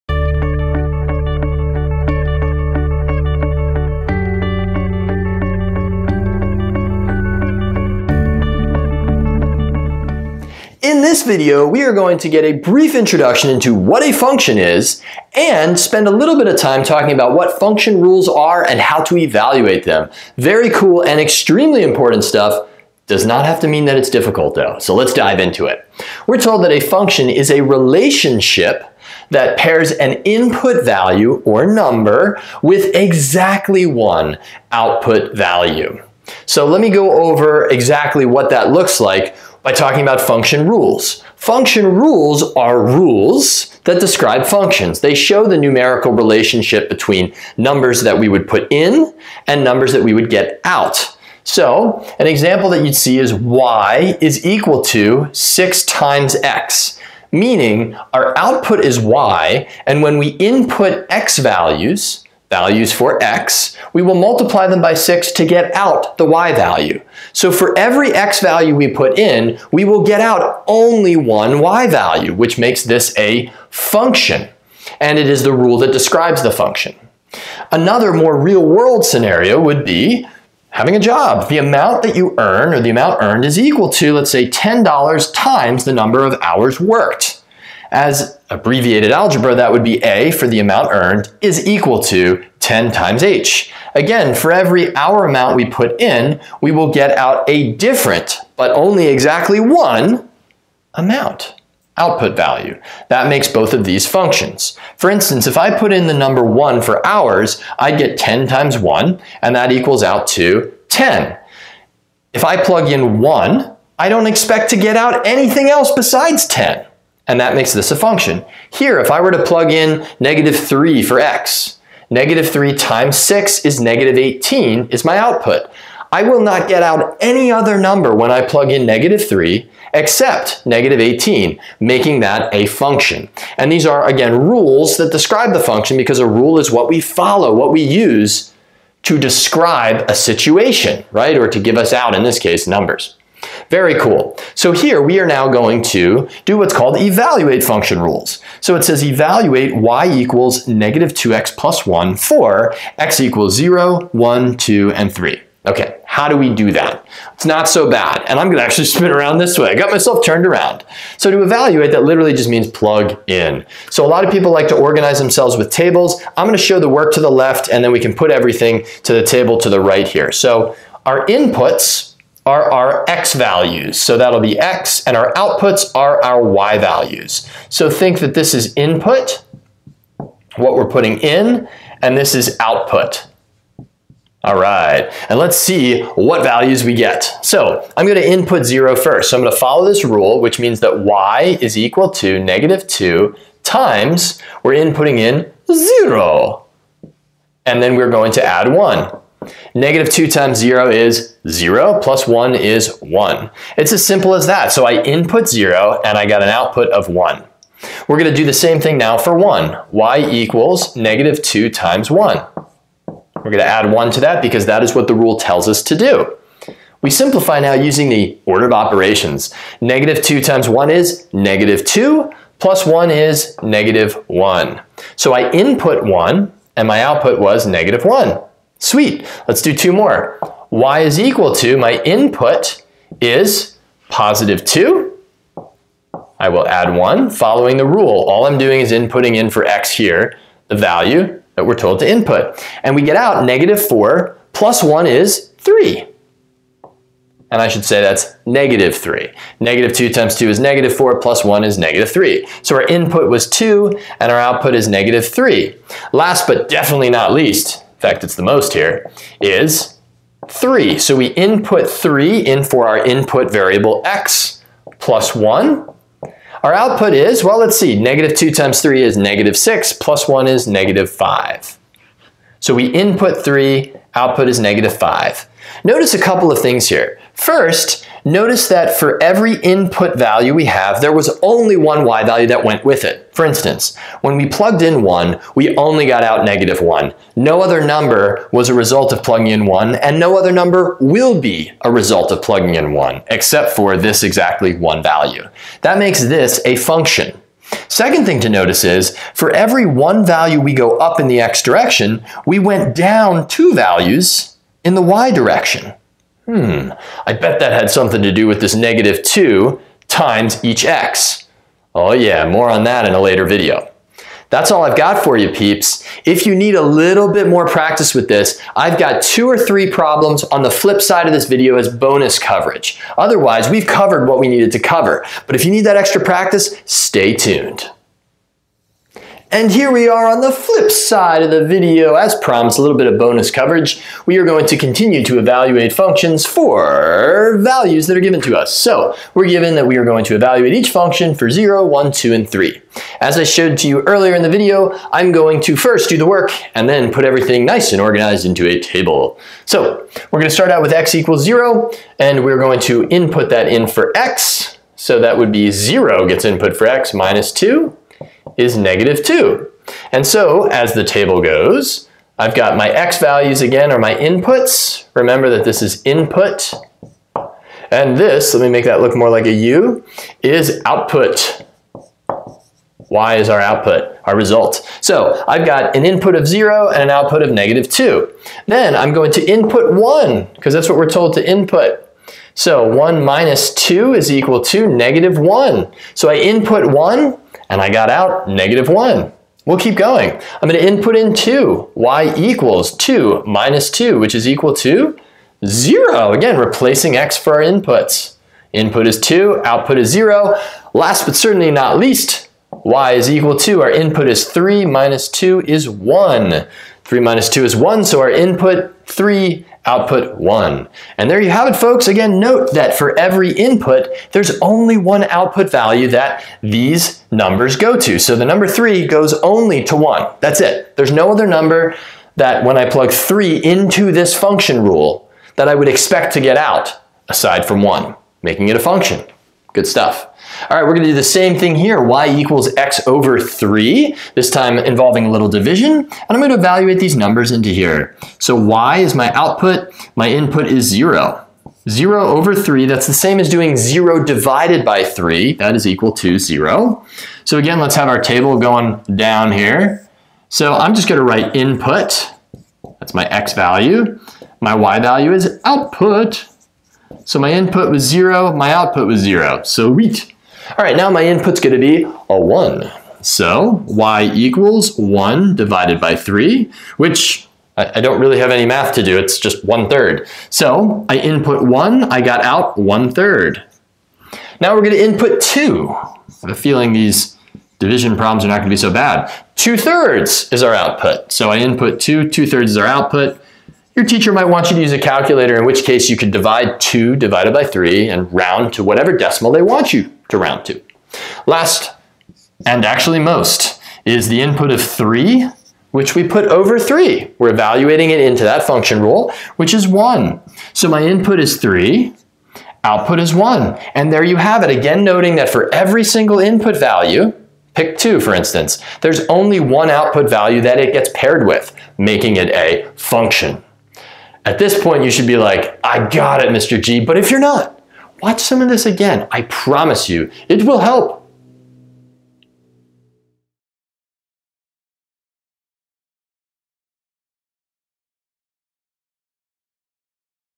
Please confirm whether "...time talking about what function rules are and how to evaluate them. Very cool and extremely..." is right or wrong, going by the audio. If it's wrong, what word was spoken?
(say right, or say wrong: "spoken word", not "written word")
right.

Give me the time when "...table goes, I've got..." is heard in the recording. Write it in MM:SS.
06:01.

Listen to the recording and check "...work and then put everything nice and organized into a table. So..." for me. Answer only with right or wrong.
right.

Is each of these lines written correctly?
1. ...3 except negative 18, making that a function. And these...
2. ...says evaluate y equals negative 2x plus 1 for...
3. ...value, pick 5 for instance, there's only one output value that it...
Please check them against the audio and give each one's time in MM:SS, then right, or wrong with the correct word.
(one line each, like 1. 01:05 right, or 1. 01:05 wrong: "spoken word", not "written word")
1. 02:09 right
2. 02:28 right
3. 08:26 wrong: "2", not "5".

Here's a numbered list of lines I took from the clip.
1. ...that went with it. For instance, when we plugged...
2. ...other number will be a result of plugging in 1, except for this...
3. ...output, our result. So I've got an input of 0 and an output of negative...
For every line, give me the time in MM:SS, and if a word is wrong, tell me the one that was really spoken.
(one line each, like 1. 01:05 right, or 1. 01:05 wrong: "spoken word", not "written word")
1. 04:42 right
2. 04:50 right
3. 06:13 right.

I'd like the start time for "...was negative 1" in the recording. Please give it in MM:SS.
03:47.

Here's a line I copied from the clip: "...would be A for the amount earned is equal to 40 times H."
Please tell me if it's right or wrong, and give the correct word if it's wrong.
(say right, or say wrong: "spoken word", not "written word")
wrong: "10", not "40".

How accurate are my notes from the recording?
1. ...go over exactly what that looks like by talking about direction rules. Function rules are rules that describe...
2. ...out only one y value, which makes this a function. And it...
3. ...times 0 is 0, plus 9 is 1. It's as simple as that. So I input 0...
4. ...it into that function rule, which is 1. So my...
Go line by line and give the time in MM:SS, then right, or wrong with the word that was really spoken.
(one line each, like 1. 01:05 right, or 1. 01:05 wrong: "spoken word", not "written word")
1. 00:36 wrong: "function", not "direction"
2. 01:10 right
3. 03:20 wrong: "1", not "9"
4. 08:18 right.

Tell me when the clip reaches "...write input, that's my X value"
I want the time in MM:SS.
07:31.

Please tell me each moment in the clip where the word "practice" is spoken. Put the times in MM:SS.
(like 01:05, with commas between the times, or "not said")
05:17, 05:26.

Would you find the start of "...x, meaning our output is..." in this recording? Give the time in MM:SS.
00:56.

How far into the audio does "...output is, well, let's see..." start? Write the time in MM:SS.
04:26.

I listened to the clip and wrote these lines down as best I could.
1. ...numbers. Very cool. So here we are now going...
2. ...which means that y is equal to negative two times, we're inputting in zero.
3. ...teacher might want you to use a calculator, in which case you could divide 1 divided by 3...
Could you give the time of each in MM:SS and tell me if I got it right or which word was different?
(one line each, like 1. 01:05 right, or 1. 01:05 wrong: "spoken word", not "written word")
1. 02:22 right
2. 03:10 right
3. 08:04 wrong: "2", not "1".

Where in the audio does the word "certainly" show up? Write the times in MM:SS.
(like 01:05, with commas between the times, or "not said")
06:41.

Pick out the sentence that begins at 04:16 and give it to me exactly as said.
Last but definitely not least, fact, it's the most here, is 3.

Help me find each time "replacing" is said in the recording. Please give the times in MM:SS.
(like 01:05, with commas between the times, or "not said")
06:36.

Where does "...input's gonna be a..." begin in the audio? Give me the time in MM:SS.
07:41.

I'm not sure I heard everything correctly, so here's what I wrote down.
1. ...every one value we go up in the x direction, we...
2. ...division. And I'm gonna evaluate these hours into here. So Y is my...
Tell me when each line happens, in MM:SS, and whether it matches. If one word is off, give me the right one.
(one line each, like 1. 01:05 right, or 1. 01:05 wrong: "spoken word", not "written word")
1. 04:59 right
2. 07:15 wrong: "numbers", not "hours".